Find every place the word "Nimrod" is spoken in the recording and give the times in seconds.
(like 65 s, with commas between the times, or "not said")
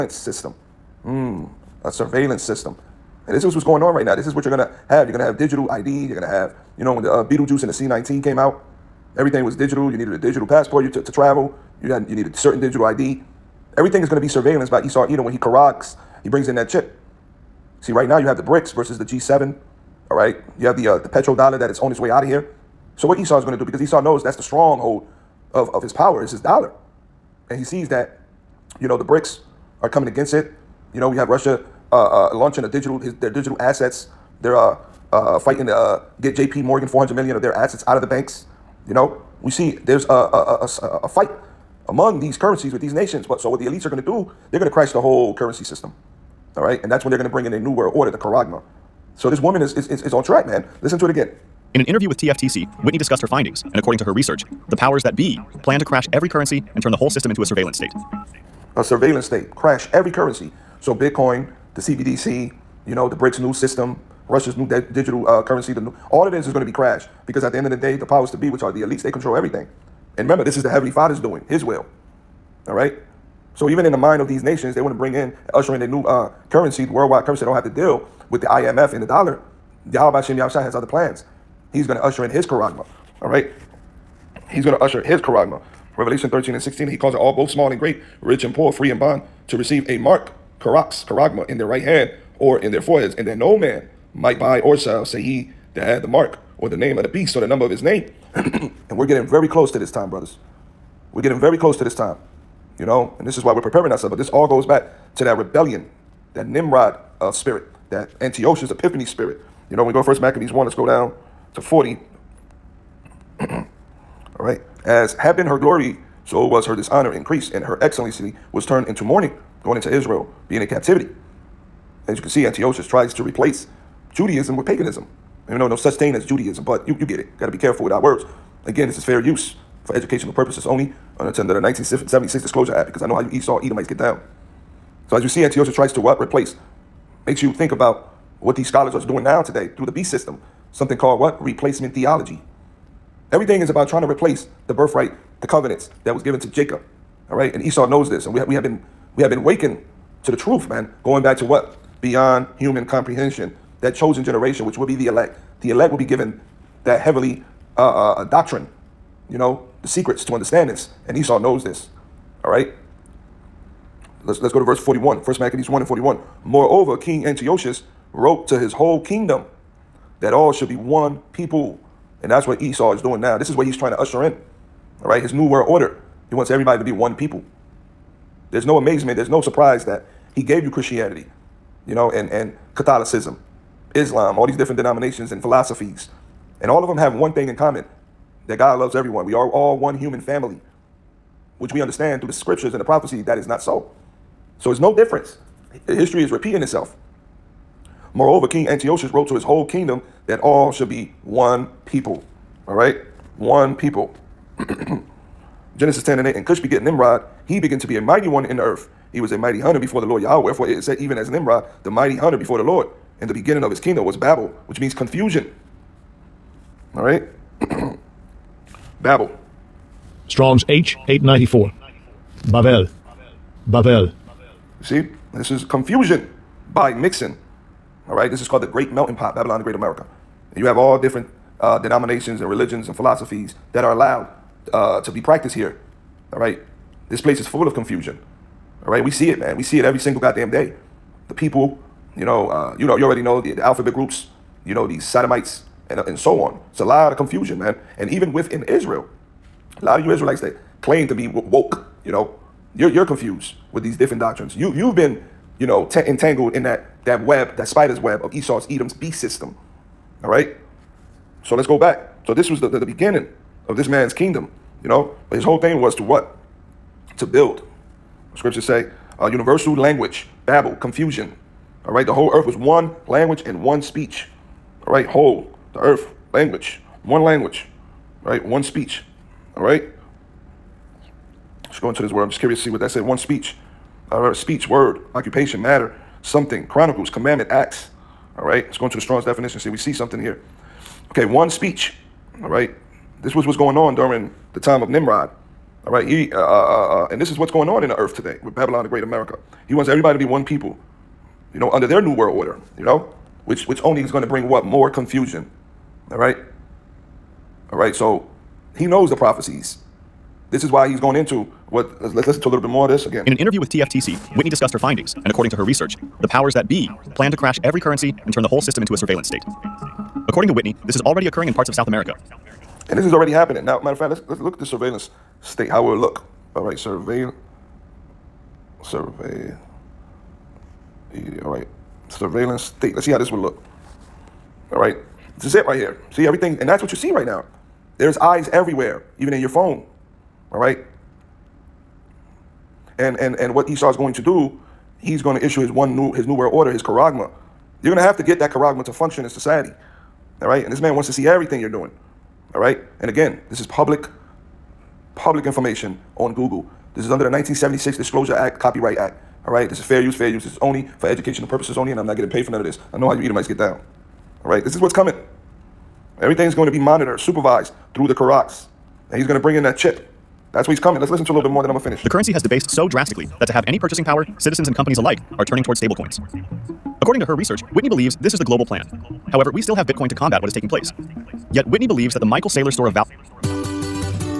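106 s, 206 s, 211 s, 294 s.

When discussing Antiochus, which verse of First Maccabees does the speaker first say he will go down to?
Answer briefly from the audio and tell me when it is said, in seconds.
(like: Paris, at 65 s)
40, at 111 s.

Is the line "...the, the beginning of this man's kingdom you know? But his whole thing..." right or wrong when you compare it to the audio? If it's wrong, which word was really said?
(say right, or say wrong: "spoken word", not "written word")
right.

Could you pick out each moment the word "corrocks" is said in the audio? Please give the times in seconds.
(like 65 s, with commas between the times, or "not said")
15 s.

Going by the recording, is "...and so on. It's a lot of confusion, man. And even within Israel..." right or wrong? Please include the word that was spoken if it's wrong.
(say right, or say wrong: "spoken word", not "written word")
right.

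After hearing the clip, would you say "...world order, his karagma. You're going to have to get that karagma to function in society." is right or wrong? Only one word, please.
right.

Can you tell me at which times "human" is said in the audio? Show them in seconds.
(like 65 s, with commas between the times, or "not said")
152 s, 189 s.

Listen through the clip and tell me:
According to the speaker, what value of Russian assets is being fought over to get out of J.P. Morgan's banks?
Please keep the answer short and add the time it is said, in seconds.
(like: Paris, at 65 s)
400 million, at 36 s.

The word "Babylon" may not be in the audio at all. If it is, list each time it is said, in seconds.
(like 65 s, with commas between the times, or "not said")
229 s, 298 s.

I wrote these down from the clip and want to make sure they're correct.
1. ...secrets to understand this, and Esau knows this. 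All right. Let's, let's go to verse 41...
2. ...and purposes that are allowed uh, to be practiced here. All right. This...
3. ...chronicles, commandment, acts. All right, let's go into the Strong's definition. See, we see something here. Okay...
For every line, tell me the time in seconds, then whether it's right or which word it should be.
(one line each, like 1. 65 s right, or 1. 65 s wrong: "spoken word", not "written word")
1. 159 s right
2. 232 s wrong: "philosophies", not "purposes"
3. 286 s right.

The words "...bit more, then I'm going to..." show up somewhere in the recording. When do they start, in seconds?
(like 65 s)
371 s.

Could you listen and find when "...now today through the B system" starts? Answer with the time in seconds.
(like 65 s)
139 s.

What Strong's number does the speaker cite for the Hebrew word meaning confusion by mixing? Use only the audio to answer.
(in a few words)
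H 894.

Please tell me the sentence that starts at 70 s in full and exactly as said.
And remember, this is the Heavenly Father's doing, His will.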